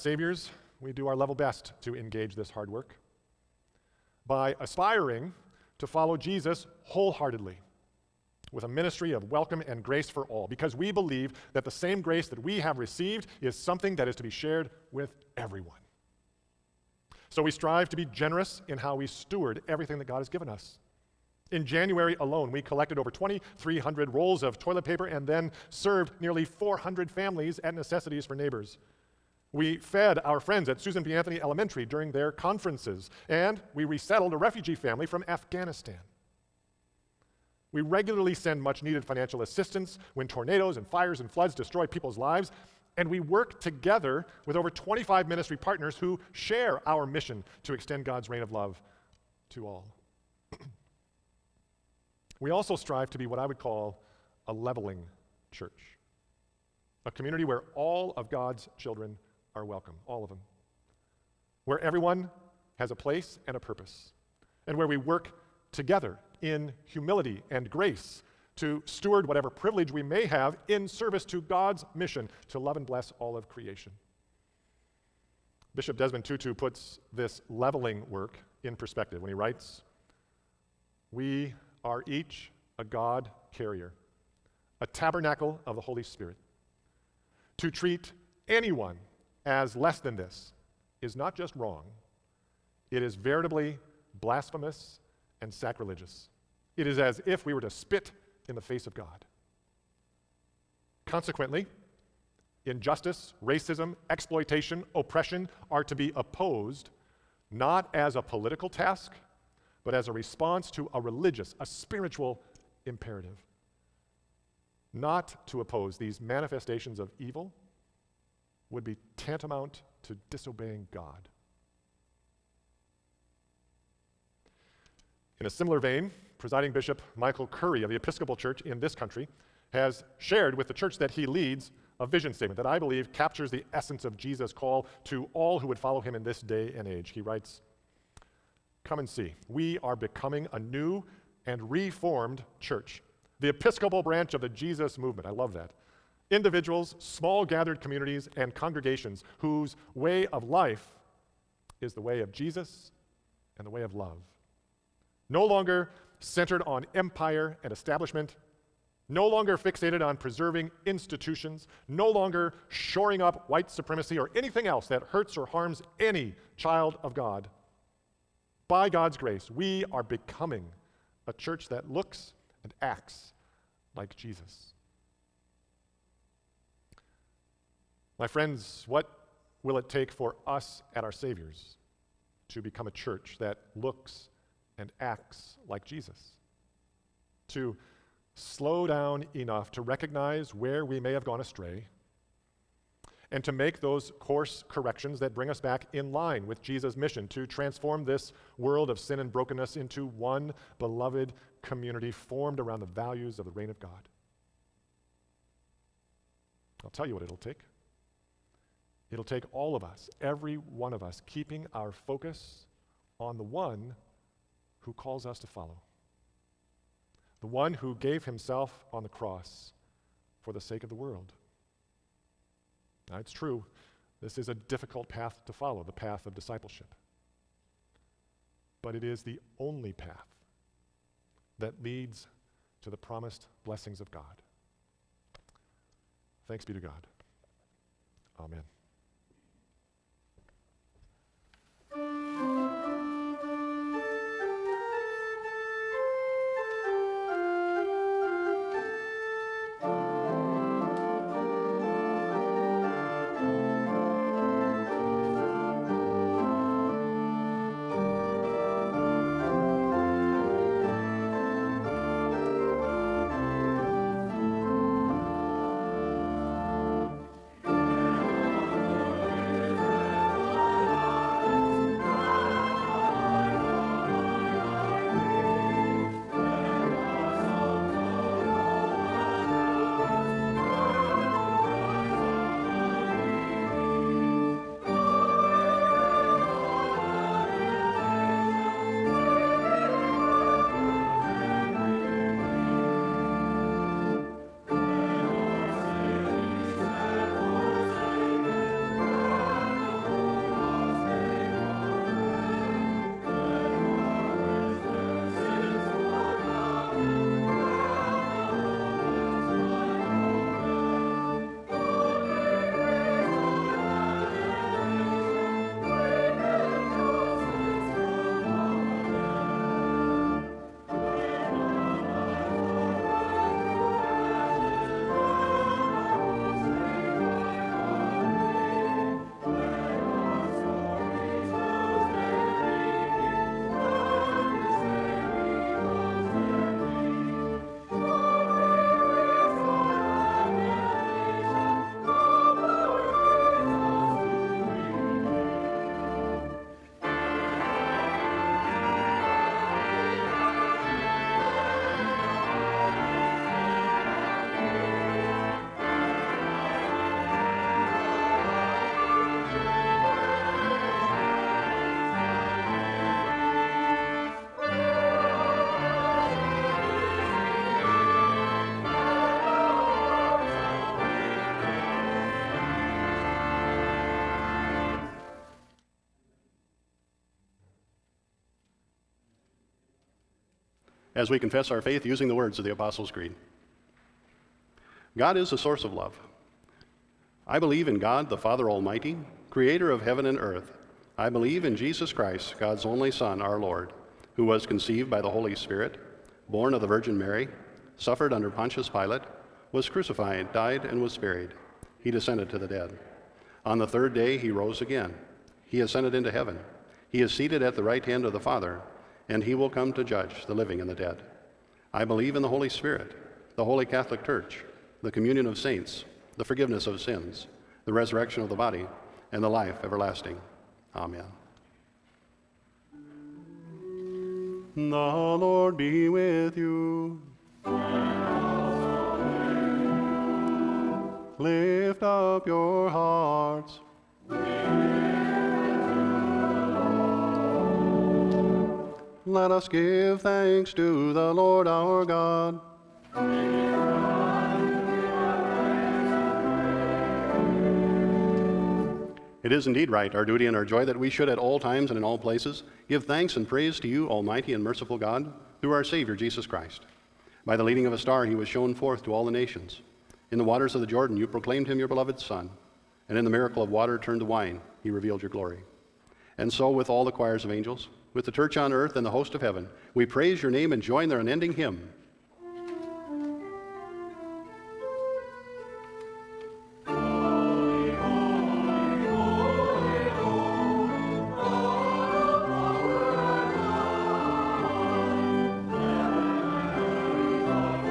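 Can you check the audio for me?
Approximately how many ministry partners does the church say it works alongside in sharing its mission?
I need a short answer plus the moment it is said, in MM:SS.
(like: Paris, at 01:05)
over 25, at 00:44.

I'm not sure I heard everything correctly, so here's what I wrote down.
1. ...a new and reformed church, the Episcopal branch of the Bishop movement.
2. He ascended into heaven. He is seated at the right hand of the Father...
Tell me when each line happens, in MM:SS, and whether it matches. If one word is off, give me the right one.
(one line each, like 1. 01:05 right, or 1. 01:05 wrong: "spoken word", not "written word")
1. 02:20 wrong: "Jesus", not "Bishop"
2. 06:45 right.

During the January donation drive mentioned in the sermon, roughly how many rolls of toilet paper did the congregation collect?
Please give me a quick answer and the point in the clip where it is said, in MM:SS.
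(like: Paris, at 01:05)
2,300, at 00:23.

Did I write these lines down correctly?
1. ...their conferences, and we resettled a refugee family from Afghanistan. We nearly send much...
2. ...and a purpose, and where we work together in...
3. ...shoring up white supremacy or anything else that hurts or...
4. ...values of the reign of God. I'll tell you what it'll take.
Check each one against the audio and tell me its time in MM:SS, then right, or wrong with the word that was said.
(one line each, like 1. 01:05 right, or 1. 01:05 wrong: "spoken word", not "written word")
1. 00:32 wrong: "regularly", not "nearly"
2. 01:03 right
3. 02:42 right
4. 03:22 right.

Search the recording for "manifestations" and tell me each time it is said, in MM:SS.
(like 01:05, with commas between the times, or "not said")
01:56.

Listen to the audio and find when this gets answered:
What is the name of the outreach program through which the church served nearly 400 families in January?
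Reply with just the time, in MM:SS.
00:27.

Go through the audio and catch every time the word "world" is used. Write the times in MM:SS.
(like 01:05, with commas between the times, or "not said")
03:18, 03:40.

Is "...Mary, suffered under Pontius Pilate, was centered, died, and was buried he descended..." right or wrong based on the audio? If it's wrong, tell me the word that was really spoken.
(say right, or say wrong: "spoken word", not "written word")
wrong: "crucified", not "centered".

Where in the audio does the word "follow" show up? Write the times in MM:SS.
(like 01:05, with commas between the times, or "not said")
00:05, 02:15, 03:35, 03:45.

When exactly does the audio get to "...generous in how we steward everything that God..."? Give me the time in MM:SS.
00:18.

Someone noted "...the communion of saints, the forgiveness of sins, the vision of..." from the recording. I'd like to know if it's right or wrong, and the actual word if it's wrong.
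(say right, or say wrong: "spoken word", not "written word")
wrong: "resurrection", not "vision".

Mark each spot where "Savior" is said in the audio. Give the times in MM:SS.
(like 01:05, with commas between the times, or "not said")
03:01, 07:35.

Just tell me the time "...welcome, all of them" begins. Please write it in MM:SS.
00:59.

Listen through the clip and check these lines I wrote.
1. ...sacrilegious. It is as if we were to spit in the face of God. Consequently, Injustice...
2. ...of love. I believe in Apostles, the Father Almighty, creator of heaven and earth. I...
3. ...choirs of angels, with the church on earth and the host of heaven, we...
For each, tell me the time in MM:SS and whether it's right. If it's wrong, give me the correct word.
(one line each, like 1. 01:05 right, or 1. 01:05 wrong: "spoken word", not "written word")
1. 01:35 right
2. 06:25 wrong: "God", not "Apostles"
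3. 07:47 right.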